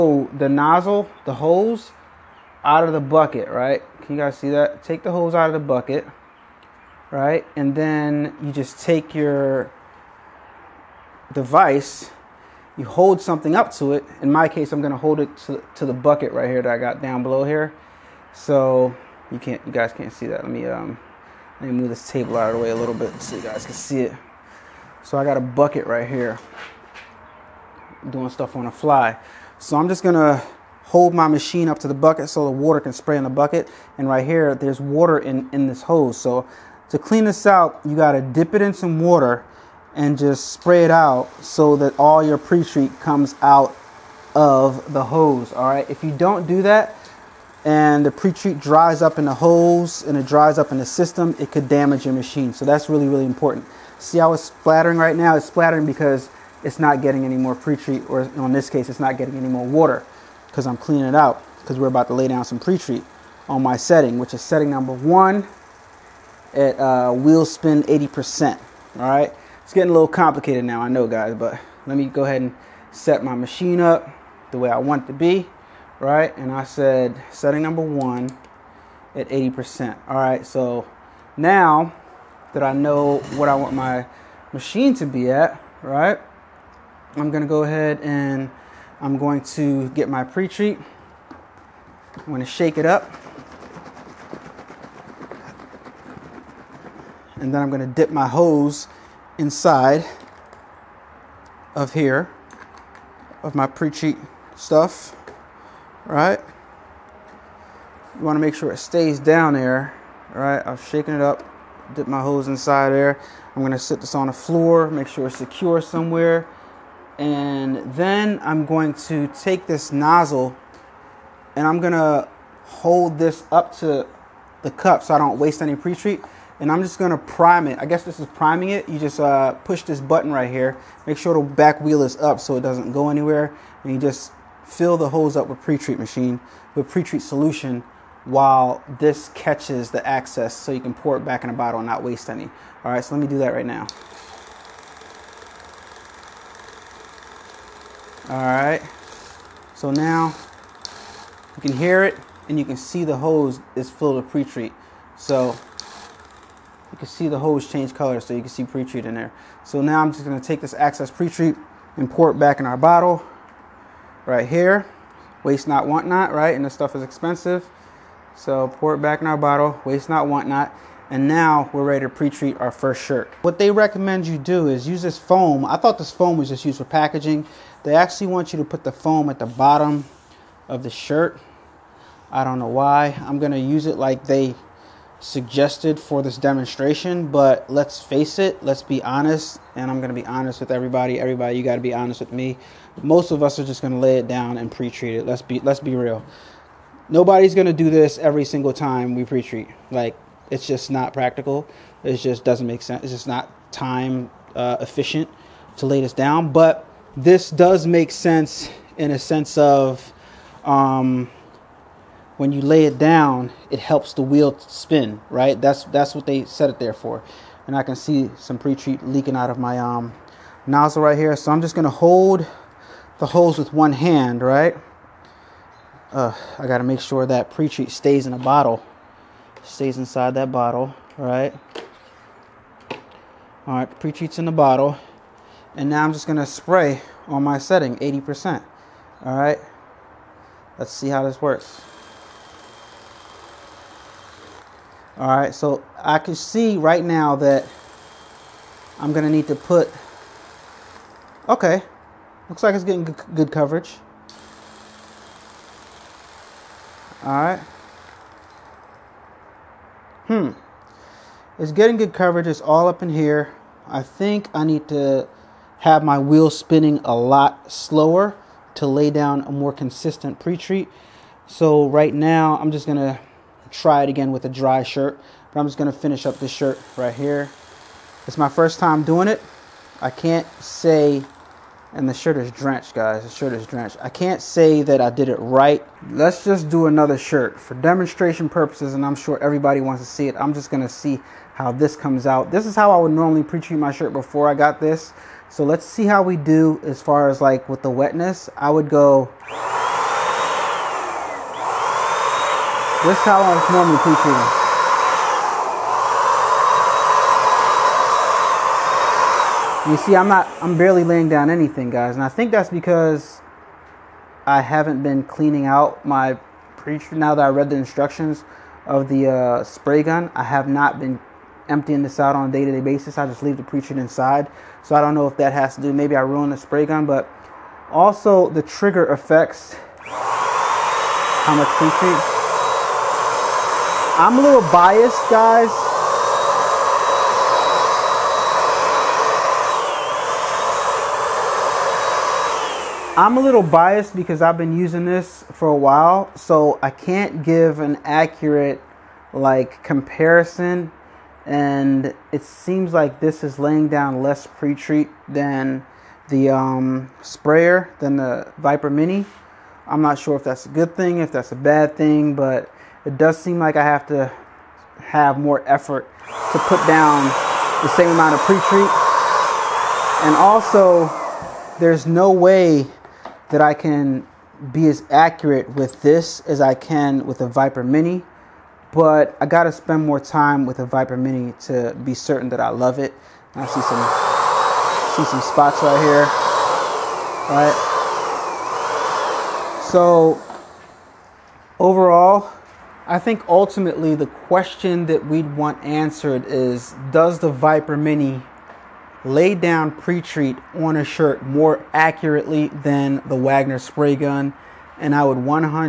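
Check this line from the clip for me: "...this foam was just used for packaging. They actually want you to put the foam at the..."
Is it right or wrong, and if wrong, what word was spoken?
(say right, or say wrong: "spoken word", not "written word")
right.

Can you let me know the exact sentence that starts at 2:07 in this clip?
I guess this is priming it.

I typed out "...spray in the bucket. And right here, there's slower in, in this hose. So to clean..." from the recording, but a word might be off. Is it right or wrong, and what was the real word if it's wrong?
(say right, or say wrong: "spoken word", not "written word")
wrong: "water", not "slower".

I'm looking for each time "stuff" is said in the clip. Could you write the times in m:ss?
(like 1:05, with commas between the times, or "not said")
0:28, 1:44, 2:46.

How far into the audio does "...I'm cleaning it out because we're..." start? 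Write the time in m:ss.
1:00.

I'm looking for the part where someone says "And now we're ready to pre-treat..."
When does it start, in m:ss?
2:51.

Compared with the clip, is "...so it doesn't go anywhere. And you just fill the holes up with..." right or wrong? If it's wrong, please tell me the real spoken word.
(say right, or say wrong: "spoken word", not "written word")
right.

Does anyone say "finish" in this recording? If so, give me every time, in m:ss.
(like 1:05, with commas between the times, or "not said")
4:35.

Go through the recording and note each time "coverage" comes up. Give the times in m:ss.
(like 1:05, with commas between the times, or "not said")
4:13, 4:22.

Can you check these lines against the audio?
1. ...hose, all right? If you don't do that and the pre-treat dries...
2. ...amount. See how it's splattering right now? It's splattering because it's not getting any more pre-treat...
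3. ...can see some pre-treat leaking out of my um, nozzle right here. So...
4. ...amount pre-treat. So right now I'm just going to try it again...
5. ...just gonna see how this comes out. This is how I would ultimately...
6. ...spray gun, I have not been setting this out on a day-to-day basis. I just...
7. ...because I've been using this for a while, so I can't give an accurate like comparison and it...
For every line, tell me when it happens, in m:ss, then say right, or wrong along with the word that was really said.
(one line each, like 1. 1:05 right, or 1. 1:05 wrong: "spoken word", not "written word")
1. 0:45 right
2. 0:53 wrong: "important", not "amount"
3. 3:37 right
4. 4:29 wrong: "consistent", not "amount"
5. 4:50 wrong: "normally", not "ultimately"
6. 5:19 wrong: "emptying", not "setting"
7. 5:44 right.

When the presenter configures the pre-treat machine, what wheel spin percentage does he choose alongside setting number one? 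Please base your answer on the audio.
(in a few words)
80%.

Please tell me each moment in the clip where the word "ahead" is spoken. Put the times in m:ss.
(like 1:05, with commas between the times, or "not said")
1:12, 1:27.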